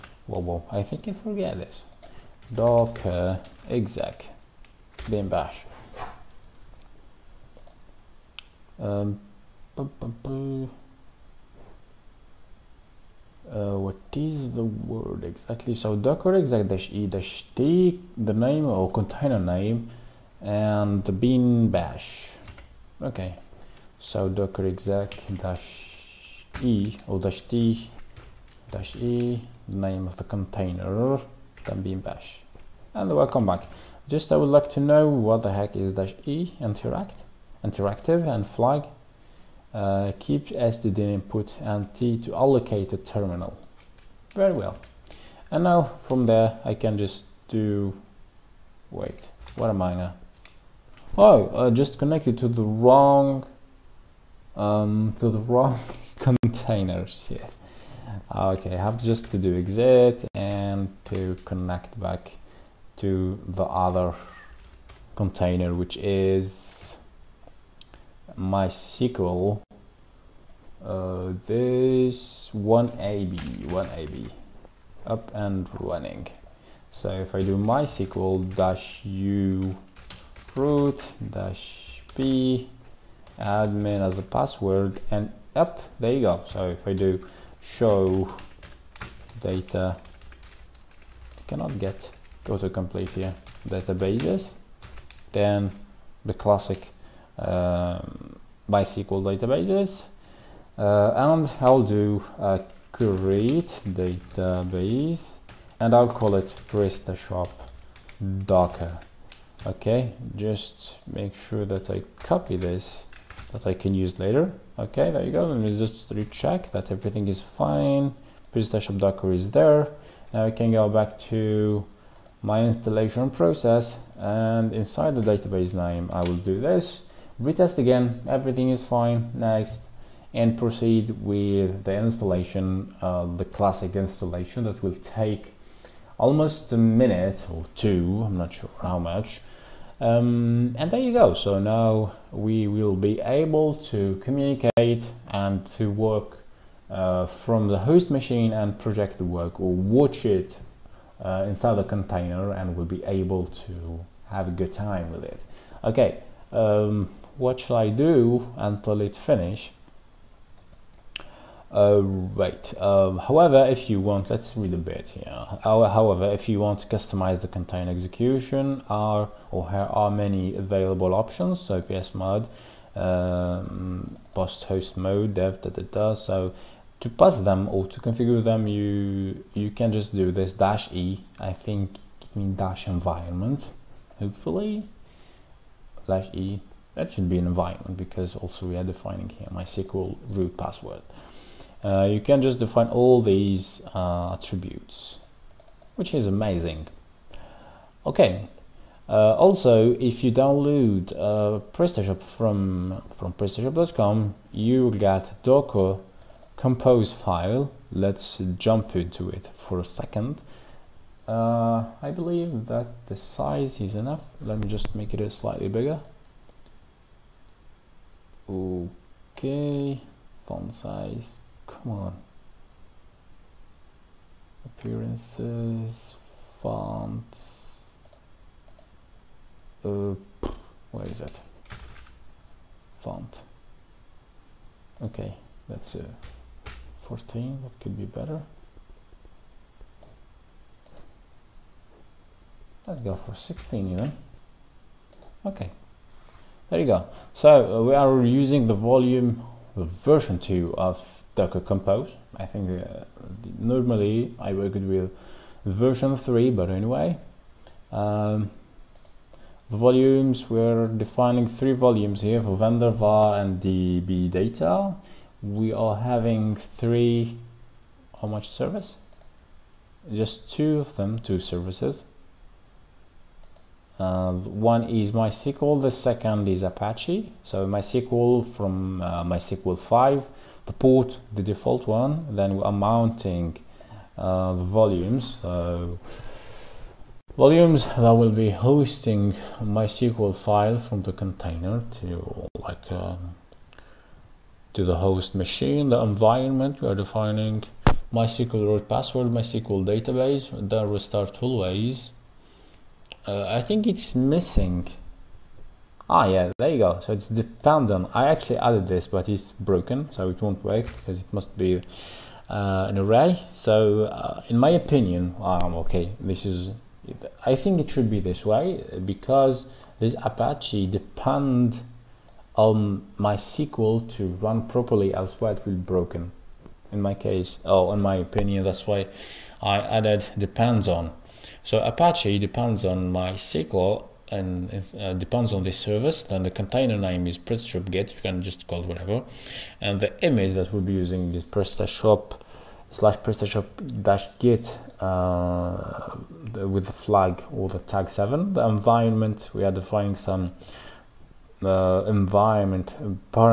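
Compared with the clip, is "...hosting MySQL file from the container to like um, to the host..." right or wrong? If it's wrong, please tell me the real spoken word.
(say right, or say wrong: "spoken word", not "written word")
right.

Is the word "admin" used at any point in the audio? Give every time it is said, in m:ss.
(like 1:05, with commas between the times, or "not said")
1:23.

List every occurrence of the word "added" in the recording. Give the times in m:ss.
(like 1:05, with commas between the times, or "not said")
5:08, 5:29.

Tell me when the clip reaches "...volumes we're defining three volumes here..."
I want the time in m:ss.
4:19.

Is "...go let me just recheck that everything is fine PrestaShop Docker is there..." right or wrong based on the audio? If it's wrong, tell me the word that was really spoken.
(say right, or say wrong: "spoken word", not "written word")
right.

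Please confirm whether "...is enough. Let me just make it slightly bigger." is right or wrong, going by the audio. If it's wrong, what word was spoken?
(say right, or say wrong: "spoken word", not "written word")
right.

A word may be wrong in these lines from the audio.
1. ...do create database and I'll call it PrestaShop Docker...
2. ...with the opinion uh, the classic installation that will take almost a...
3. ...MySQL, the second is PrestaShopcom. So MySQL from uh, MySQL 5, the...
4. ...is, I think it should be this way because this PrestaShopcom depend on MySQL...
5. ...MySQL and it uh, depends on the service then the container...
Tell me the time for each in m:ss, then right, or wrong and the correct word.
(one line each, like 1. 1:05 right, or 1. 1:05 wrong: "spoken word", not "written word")
1. 1:41 right
2. 2:11 wrong: "installation", not "opinion"
3. 4:35 wrong: "Apache", not "PrestaShopcom"
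4. 5:16 wrong: "Apache", not "PrestaShopcom"
5. 5:33 right.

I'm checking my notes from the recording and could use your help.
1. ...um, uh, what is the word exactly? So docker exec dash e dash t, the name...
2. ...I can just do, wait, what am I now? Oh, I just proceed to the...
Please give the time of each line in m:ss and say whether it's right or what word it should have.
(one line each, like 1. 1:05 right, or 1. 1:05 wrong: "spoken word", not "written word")
1. 0:08 right
2. 0:46 wrong: "connected", not "proceed".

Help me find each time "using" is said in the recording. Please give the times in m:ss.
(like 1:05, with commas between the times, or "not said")
4:08, 5:40.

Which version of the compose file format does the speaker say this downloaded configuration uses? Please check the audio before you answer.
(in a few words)
version 2.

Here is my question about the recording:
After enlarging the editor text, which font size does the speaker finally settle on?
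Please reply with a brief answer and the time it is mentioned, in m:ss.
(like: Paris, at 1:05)
16, at 4:03.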